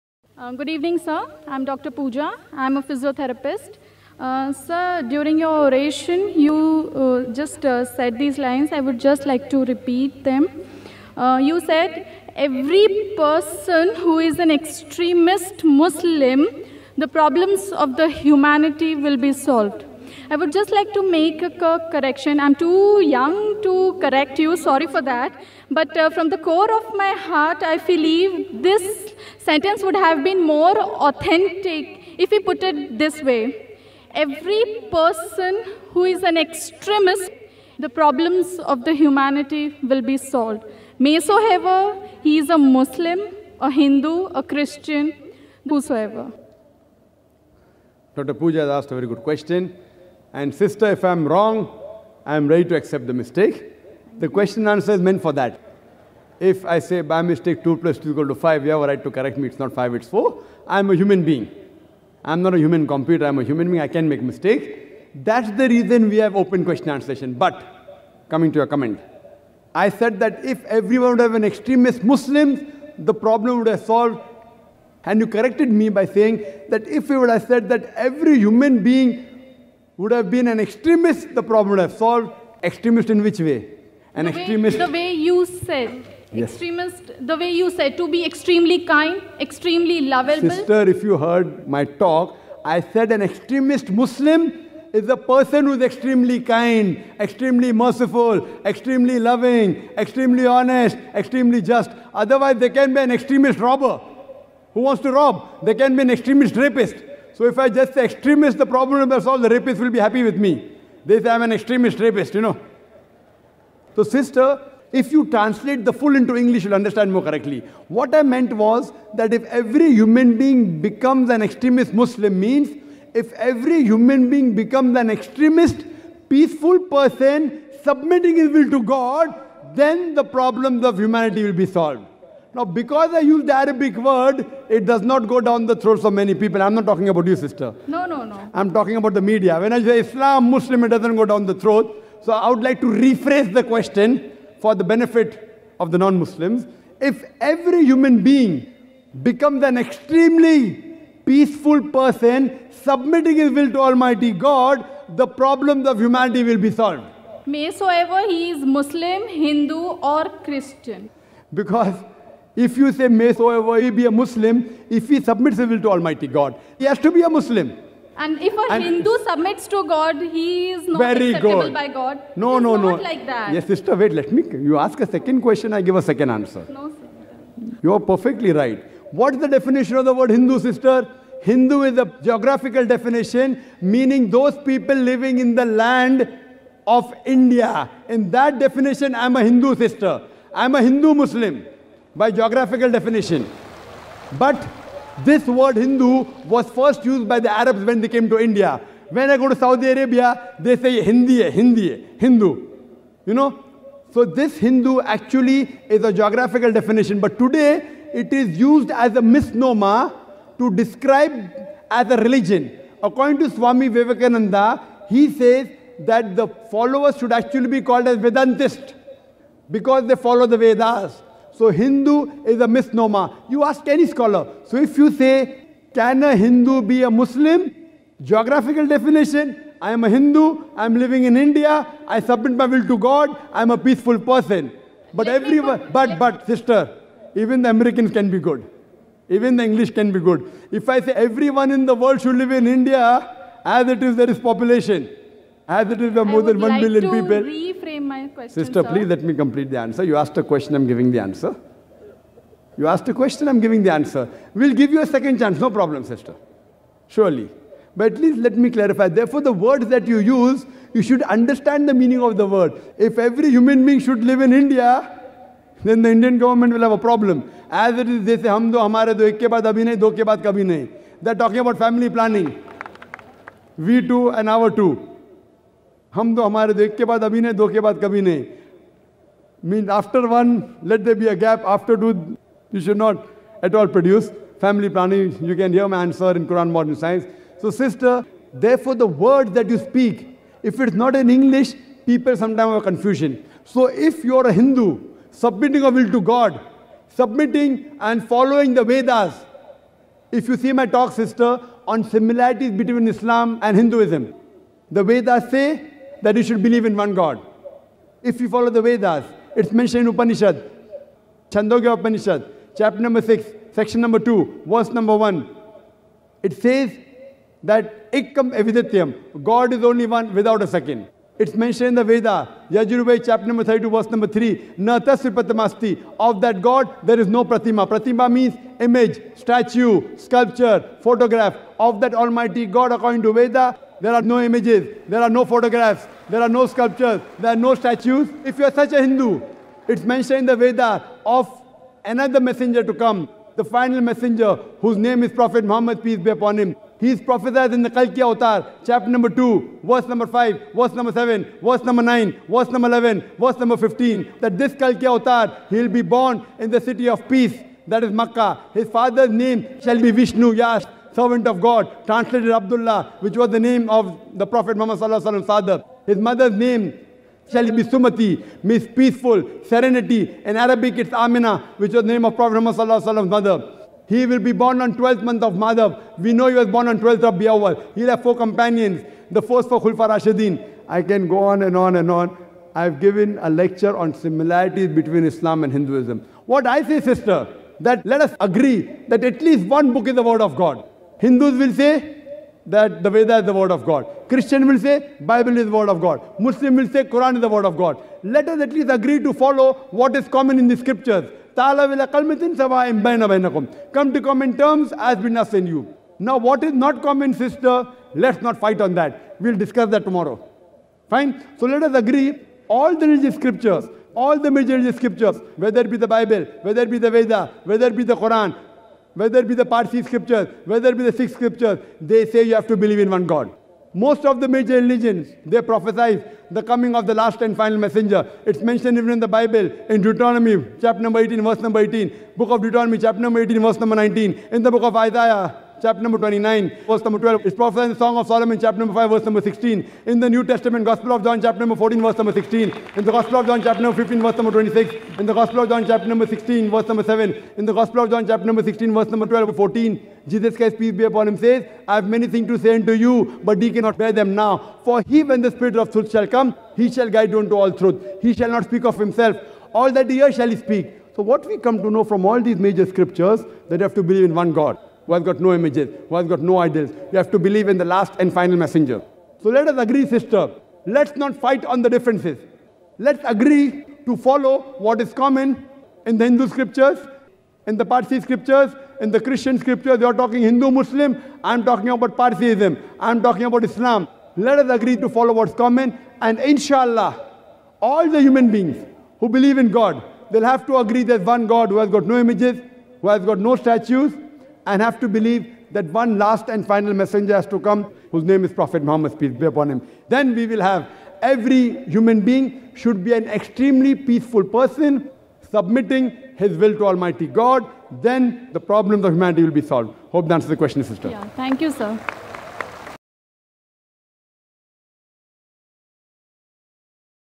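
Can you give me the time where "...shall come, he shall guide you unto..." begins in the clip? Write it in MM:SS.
07:36.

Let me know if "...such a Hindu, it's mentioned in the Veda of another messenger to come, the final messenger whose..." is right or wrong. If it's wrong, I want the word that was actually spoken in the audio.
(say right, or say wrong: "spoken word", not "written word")
right.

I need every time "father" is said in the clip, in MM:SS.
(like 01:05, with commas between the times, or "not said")
05:58.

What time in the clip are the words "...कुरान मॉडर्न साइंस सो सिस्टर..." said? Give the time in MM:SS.
04:46.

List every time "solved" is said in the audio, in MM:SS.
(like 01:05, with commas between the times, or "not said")
00:19, 00:40, 01:13, 01:21, 01:49, 02:11, 02:36, 08:29.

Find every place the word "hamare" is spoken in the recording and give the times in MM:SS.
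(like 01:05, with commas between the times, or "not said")
04:28.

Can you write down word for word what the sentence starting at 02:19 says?
When I say Islam, Muslim, it doesn't go down the throat.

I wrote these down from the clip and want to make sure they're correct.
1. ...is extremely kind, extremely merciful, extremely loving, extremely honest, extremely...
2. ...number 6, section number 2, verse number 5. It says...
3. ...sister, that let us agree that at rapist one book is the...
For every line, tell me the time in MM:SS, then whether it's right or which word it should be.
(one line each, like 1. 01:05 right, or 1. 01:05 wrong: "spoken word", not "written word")
1. 01:35 right
2. 05:12 wrong: "1", not "5"
3. 06:26 wrong: "least", not "rapist".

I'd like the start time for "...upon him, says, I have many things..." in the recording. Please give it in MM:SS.
07:31.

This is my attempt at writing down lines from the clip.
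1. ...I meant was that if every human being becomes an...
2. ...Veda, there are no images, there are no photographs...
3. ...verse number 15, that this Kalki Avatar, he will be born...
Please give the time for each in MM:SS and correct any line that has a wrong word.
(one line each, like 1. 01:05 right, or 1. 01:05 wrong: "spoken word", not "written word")
1. 01:58 right
2. 05:33 right
3. 05:53 right.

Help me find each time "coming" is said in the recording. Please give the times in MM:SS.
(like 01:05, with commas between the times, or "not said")
01:08, 07:06.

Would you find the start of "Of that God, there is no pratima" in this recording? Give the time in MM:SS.
05:26.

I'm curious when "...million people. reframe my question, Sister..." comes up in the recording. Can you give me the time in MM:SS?
04:06.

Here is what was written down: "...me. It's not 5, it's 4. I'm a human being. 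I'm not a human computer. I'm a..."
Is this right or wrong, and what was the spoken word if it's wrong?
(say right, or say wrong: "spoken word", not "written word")
right.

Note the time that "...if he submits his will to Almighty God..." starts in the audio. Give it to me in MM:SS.
02:44.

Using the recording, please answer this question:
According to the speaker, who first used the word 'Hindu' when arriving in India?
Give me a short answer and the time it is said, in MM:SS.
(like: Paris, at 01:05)
The Arabs, at 03:17.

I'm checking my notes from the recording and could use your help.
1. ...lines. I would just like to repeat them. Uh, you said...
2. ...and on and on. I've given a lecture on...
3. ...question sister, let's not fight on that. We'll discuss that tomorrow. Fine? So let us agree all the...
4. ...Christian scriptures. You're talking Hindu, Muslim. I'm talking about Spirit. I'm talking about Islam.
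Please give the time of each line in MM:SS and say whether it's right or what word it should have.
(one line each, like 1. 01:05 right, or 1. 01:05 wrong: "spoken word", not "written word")
1. 00:08 right
2. 06:21 right
3. 06:47 wrong: "common", not "question"
4. 07:59 wrong: "Parsiism", not "Spirit".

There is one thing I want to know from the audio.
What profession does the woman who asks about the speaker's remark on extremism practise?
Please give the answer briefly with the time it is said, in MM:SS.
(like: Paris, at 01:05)
Physiotherapist, at 00:02.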